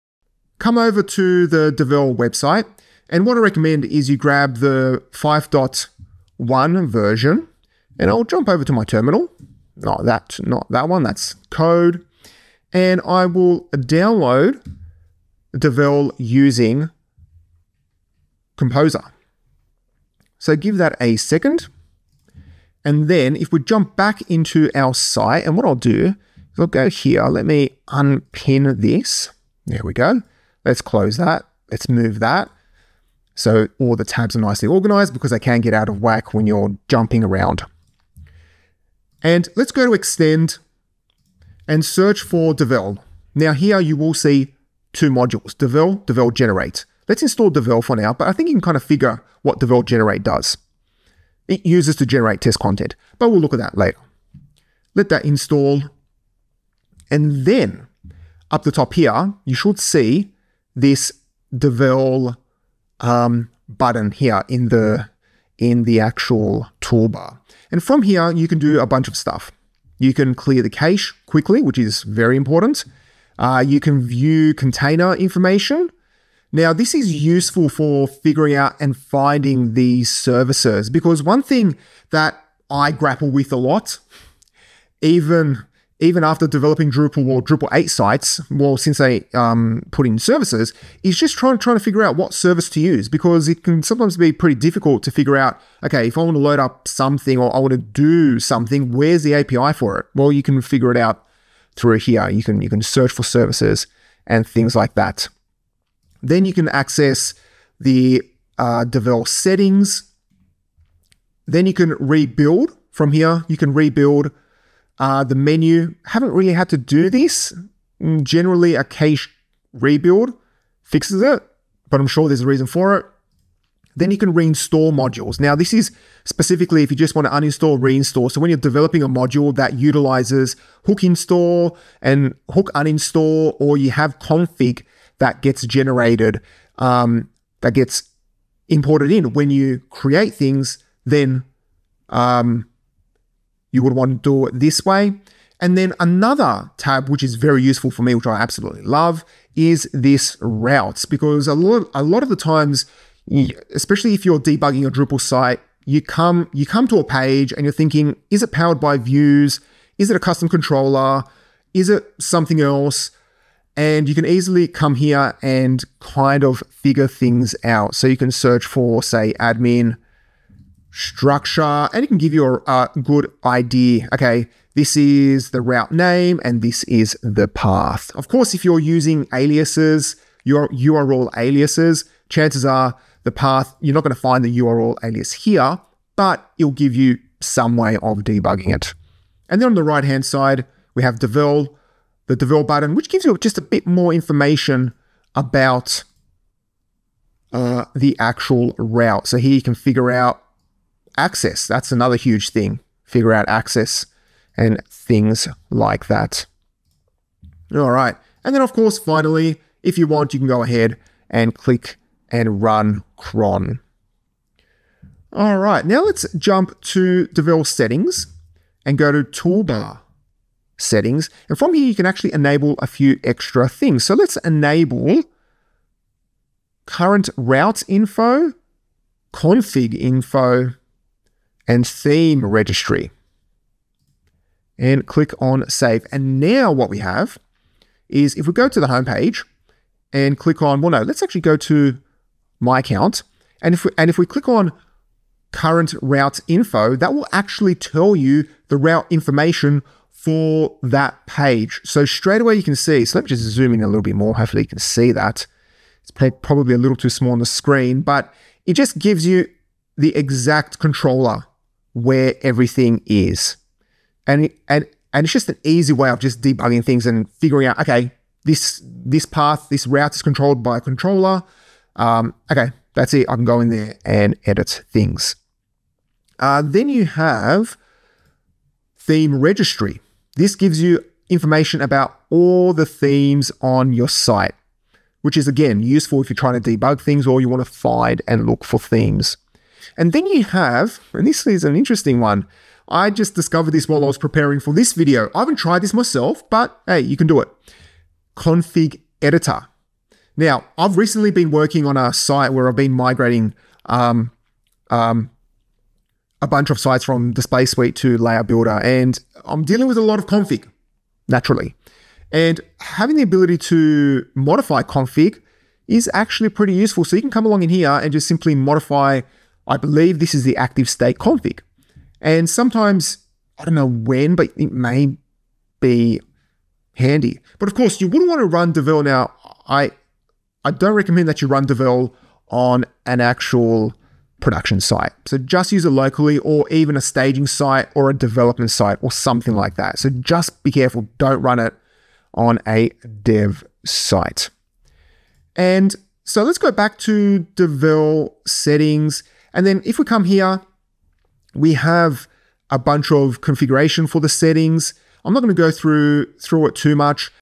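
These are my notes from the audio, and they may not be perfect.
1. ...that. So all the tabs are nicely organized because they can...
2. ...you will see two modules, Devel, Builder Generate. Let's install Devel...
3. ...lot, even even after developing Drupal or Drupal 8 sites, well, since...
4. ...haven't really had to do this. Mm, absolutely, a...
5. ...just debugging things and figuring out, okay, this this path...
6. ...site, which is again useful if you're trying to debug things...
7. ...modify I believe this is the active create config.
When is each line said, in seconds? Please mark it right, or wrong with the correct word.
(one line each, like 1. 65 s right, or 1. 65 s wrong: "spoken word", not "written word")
1. 32 s right
2. 43 s wrong: "Devel", not "Builder"
3. 83 s right
4. 116 s wrong: "generally", not "absolutely"
5. 266 s right
6. 284 s right
7. 318 s wrong: "state", not "create".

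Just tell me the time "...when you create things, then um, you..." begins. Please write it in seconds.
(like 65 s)
139 s.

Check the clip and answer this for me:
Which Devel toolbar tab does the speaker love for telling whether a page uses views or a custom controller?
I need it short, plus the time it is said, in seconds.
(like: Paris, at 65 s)
routes, at 150 s.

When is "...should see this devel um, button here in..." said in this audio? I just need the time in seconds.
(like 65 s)
59 s.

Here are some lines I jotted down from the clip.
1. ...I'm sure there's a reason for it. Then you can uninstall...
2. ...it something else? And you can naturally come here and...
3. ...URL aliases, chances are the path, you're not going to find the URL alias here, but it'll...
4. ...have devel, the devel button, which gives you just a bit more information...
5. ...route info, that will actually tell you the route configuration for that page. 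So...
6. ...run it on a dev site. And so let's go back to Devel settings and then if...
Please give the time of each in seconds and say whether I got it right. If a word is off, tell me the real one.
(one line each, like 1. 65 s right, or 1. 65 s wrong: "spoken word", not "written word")
1. 121 s wrong: "reinstall", not "uninstall"
2. 161 s wrong: "easily", not "naturally"
3. 180 s right
4. 191 s right
5. 246 s wrong: "information", not "configuration"
6. 341 s right.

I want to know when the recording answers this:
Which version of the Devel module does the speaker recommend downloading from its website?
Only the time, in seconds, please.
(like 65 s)
5 s.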